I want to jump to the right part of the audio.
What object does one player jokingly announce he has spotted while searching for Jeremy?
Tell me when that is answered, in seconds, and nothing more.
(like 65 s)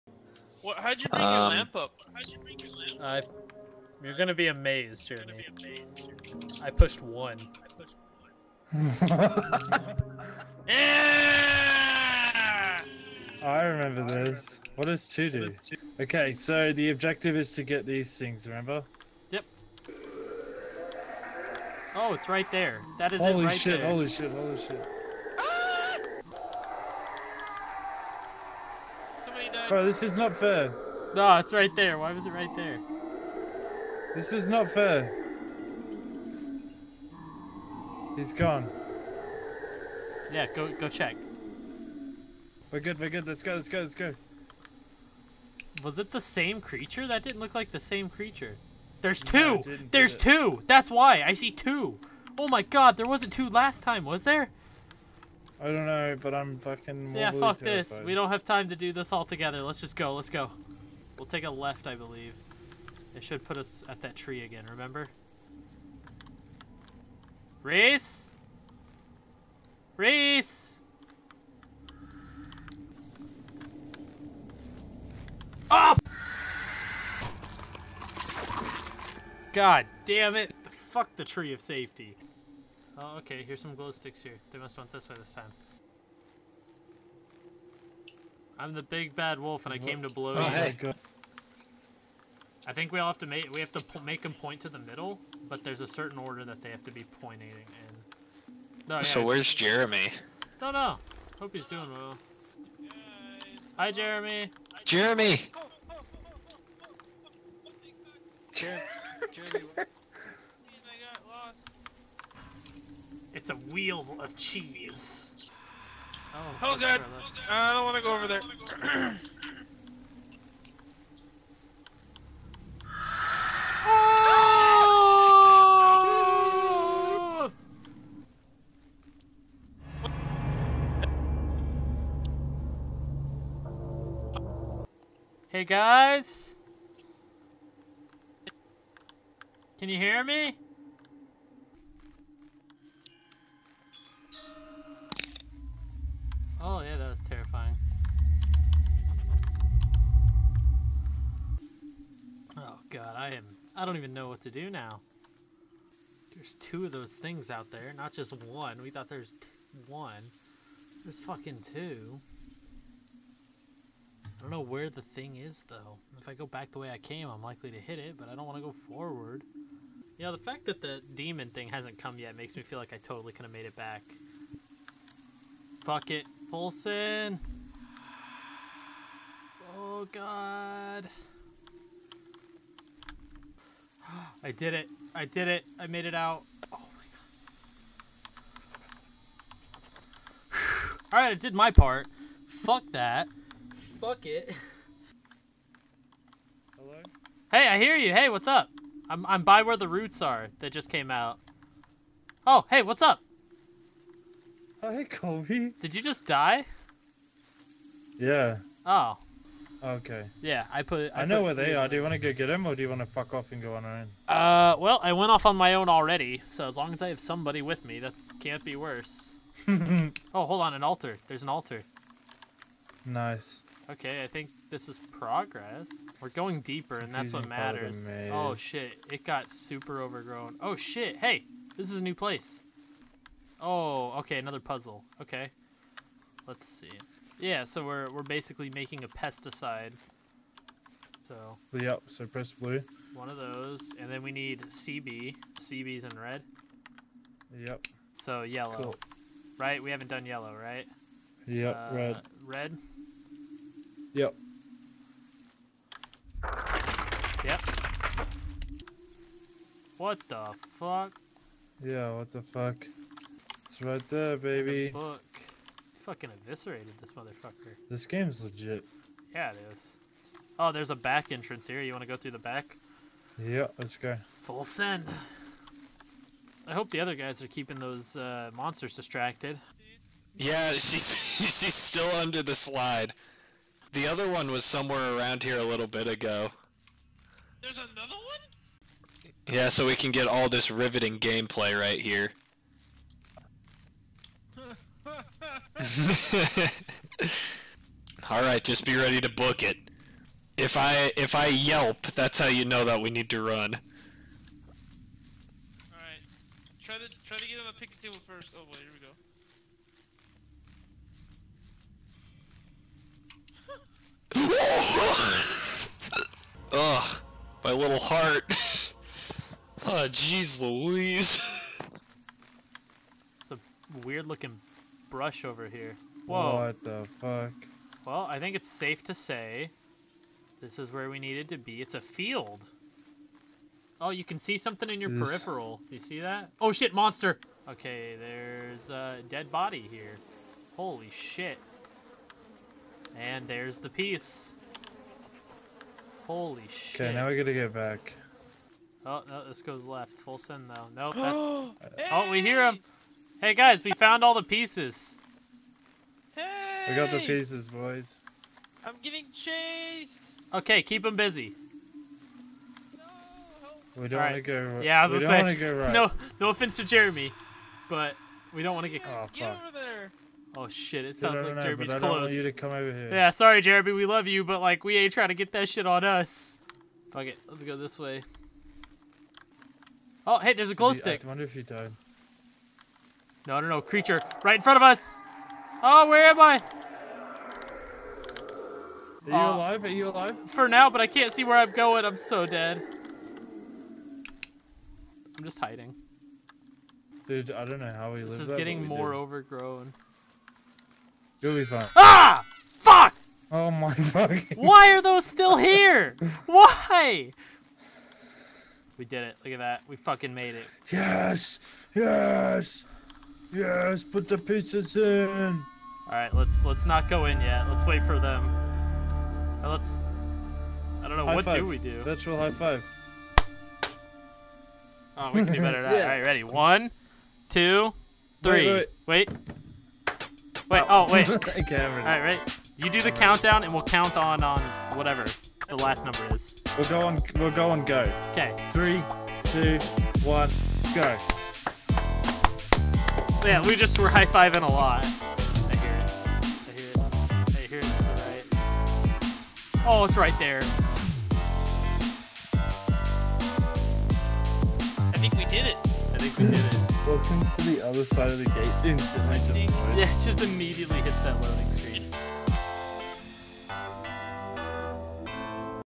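113 s.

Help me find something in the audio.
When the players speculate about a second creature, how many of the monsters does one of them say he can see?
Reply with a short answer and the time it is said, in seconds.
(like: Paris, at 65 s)
2, at 51 s.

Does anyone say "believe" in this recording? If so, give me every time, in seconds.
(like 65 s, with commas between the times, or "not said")
61 s.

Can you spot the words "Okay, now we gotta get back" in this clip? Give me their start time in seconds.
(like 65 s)
347 s.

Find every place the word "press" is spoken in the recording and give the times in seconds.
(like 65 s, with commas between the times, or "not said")
242 s.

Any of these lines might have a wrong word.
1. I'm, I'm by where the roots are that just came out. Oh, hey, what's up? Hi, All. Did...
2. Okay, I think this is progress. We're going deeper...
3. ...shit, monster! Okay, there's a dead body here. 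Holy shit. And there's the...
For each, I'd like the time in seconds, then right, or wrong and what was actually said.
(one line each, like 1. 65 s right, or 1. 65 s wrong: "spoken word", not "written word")
1. 199 s wrong: "Kobe", not "All"
2. 223 s right
3. 336 s right.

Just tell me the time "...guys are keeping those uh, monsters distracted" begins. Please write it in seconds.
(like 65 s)
277 s.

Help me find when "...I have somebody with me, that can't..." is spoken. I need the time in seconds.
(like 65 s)
217 s.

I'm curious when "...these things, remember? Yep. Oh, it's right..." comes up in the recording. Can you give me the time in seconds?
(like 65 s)
17 s.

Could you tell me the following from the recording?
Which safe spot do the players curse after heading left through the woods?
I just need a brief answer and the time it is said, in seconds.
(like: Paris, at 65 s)
the tree of safety, at 81 s.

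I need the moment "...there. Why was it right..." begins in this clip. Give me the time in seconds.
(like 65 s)
31 s.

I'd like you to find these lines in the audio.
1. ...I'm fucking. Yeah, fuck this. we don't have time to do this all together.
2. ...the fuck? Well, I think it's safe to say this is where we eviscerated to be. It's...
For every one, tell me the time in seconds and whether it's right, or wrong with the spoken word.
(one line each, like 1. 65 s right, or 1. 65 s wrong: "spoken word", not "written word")
1. 56 s right
2. 326 s wrong: "needed", not "eviscerated".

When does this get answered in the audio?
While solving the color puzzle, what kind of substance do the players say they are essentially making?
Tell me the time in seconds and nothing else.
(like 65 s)
239 s.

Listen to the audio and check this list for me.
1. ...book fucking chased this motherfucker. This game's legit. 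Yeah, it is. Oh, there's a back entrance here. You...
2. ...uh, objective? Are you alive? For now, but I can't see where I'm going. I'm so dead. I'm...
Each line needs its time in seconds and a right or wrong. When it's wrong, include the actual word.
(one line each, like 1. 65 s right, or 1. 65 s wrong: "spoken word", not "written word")
1. 264 s wrong: "eviscerated", not "chased"
2. 389 s wrong: "alive", not "objective".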